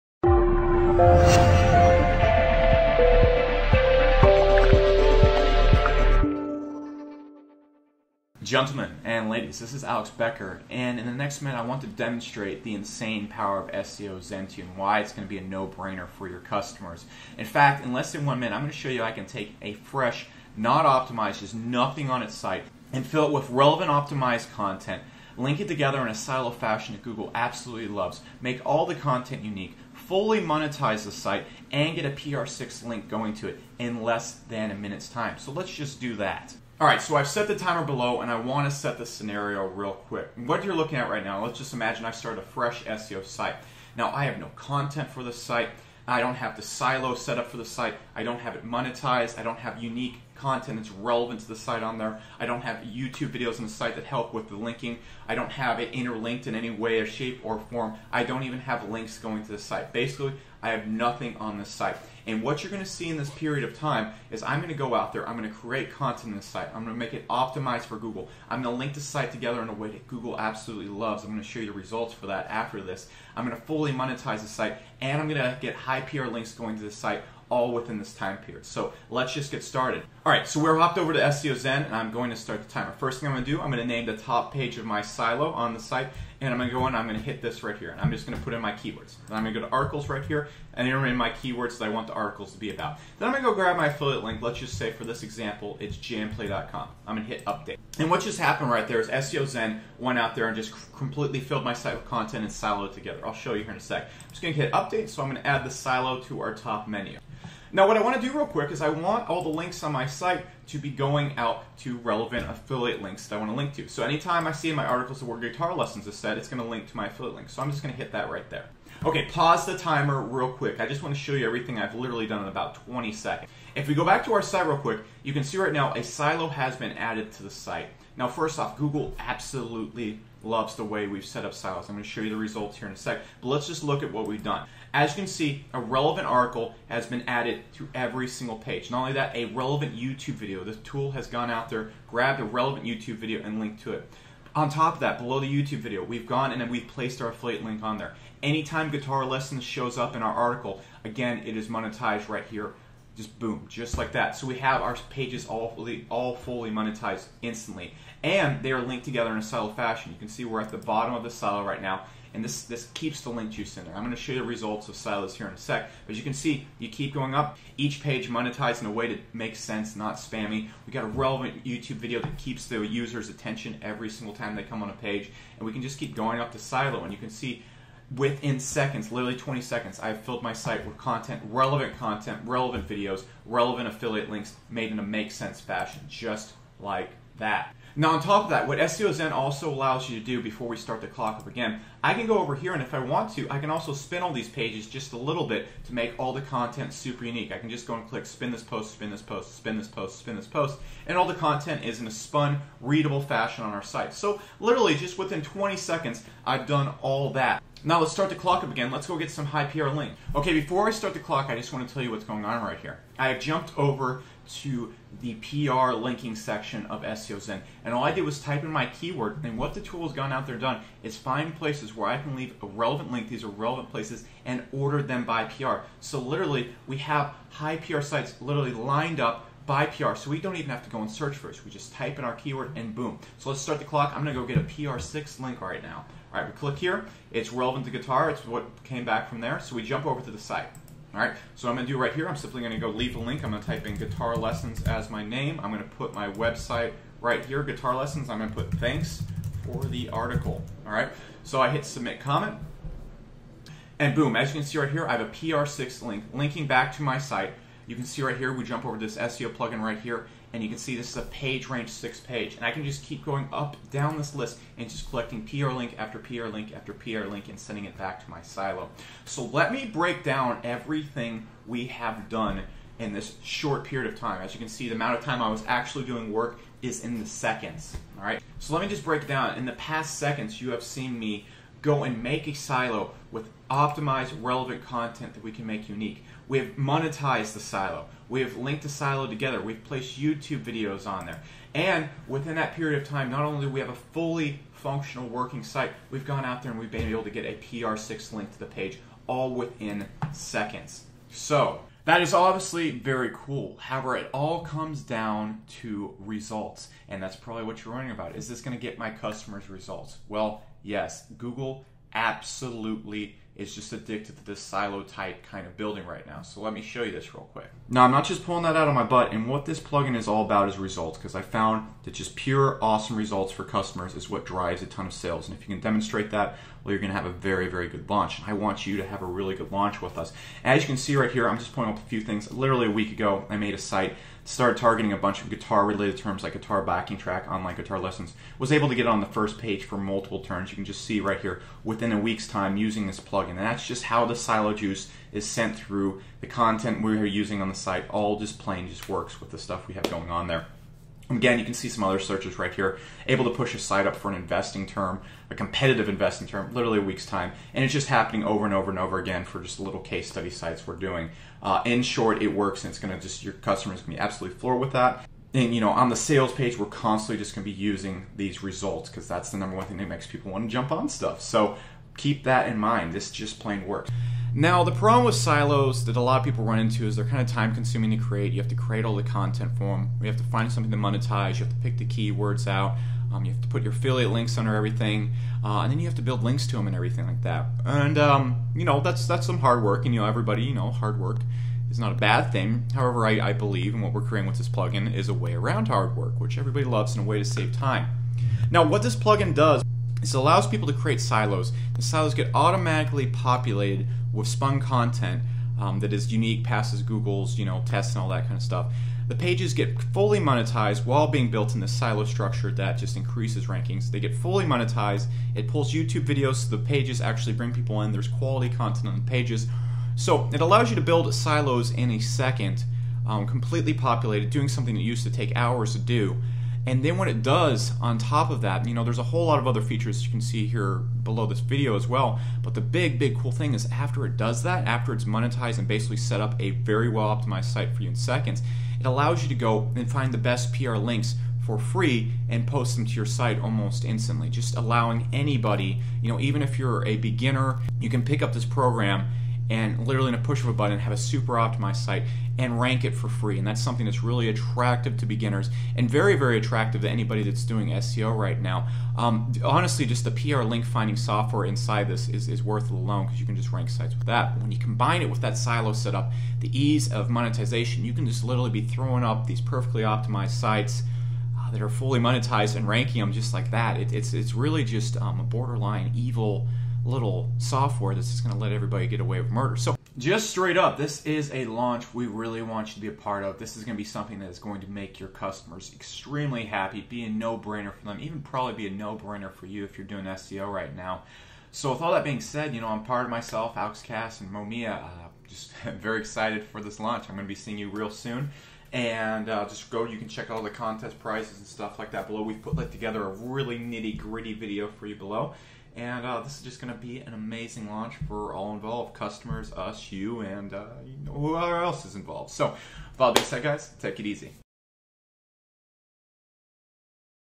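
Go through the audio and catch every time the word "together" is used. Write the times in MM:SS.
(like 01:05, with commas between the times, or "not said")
00:25, 01:09, 01:42, 02:39, 04:49, 08:22.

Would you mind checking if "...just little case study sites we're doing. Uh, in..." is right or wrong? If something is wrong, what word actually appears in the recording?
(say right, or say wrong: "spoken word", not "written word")
right.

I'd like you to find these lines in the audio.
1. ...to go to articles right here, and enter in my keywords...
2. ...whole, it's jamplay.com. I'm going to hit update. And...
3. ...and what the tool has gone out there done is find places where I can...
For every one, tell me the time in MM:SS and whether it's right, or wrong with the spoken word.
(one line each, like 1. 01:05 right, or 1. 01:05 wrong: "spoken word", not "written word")
1. 01:29 right
2. 01:35 wrong: "example", not "whole"
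3. 03:39 right.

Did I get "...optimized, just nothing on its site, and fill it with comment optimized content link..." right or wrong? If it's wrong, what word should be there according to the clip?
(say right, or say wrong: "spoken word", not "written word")
wrong: "relevant", not "comment".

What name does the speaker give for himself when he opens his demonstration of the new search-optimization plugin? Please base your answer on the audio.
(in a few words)
Alex Becker.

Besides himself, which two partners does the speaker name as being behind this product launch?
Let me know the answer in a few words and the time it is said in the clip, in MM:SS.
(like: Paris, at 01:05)
AuxCast and Momia, at 08:13.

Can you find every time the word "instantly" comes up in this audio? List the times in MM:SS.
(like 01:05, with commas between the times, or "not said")
02:37, 07:24.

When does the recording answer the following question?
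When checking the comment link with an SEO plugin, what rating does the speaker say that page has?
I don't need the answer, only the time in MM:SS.
04:21.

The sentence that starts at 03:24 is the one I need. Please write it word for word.
So literally just within 20 seconds, I've done all that.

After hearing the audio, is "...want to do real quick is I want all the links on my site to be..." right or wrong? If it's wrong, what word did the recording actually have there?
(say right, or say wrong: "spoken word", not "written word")
right.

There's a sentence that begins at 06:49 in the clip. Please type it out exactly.
The pages get fully monetized while being built in this silo structure that just increases rankings.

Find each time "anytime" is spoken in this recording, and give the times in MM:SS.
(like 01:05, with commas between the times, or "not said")
01:54, 02:28.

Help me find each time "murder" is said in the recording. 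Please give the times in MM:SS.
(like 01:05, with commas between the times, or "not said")
07:59.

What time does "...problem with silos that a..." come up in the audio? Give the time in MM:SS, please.
06:14.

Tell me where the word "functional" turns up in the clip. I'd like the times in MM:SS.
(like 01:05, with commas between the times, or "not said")
04:54.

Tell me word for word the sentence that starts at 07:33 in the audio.
And that's something that's really attractive to beginners and very, very attractive to anybody that's doing SEO right now.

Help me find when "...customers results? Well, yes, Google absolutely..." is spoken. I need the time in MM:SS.
05:09.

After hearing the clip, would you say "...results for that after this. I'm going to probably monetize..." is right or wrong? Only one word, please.
wrong.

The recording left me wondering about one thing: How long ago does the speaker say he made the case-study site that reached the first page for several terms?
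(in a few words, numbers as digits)
a week ago.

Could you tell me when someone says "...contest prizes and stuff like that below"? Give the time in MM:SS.
08:20.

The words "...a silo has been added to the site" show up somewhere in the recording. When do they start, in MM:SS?
02:05.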